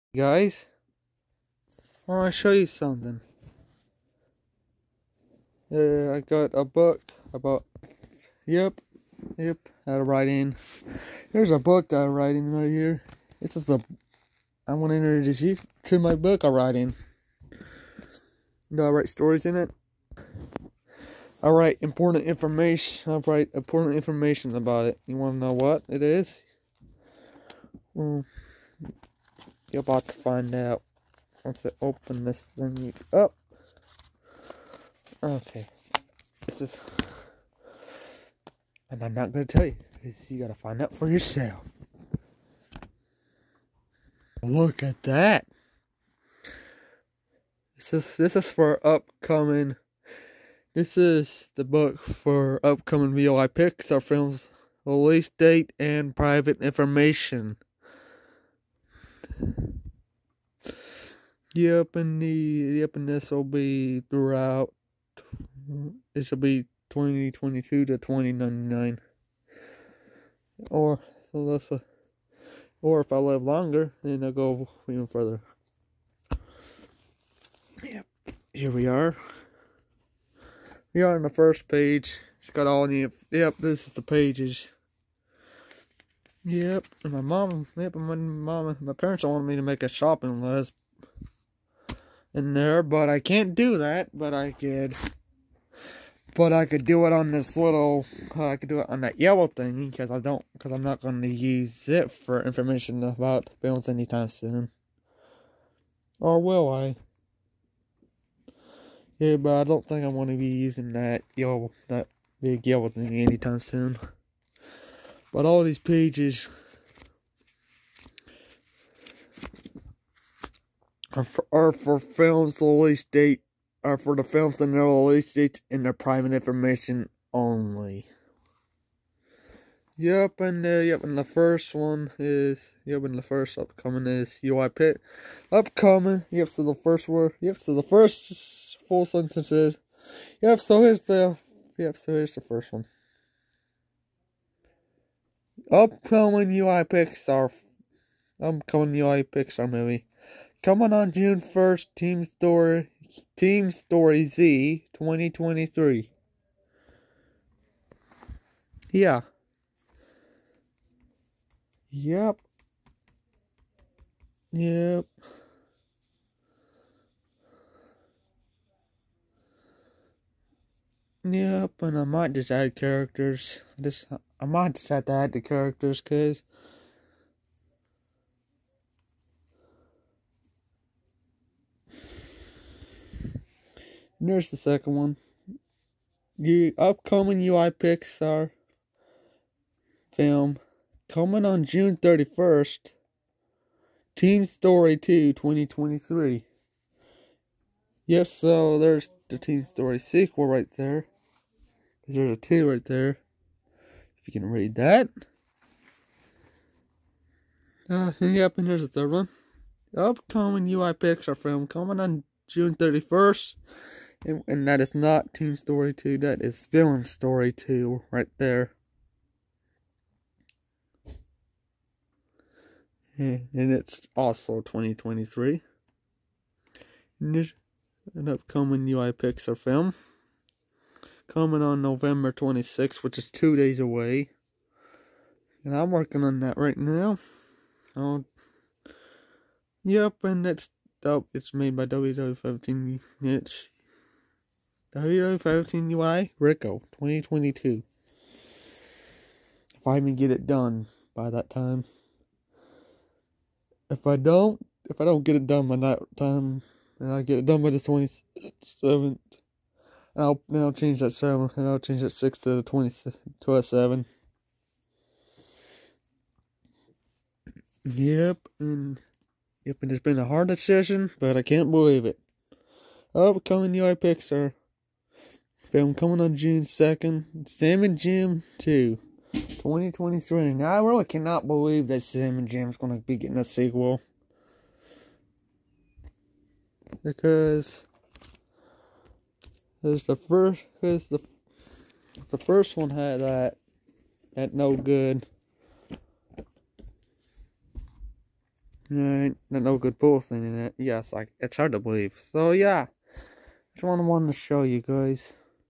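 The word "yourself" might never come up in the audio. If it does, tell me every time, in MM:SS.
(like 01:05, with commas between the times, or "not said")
00:41.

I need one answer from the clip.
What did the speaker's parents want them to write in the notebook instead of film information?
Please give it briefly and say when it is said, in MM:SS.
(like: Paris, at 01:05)
A shopping list, at 01:29.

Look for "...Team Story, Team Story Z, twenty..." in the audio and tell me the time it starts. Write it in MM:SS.
02:31.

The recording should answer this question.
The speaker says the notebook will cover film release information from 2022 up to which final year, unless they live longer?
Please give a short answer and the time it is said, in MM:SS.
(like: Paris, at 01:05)
2099, at 01:07.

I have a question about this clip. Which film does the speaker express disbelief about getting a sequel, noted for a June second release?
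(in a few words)
Sam and Jim 2.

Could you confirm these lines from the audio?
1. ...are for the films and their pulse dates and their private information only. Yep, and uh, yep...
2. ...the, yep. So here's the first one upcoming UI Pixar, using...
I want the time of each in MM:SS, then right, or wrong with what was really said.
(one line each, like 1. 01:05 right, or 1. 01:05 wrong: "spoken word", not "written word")
1. 02:03 wrong: "release", not "pulse"
2. 02:21 wrong: "upcoming", not "using".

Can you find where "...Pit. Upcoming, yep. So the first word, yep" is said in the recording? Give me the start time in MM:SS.
02:14.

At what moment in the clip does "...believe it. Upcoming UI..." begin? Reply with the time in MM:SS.
04:31.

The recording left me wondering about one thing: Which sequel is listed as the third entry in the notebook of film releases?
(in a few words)
Villain Story 2.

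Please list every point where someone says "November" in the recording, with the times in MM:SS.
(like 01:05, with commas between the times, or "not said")
03:51.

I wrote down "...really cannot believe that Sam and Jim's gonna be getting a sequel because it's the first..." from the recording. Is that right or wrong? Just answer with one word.
right.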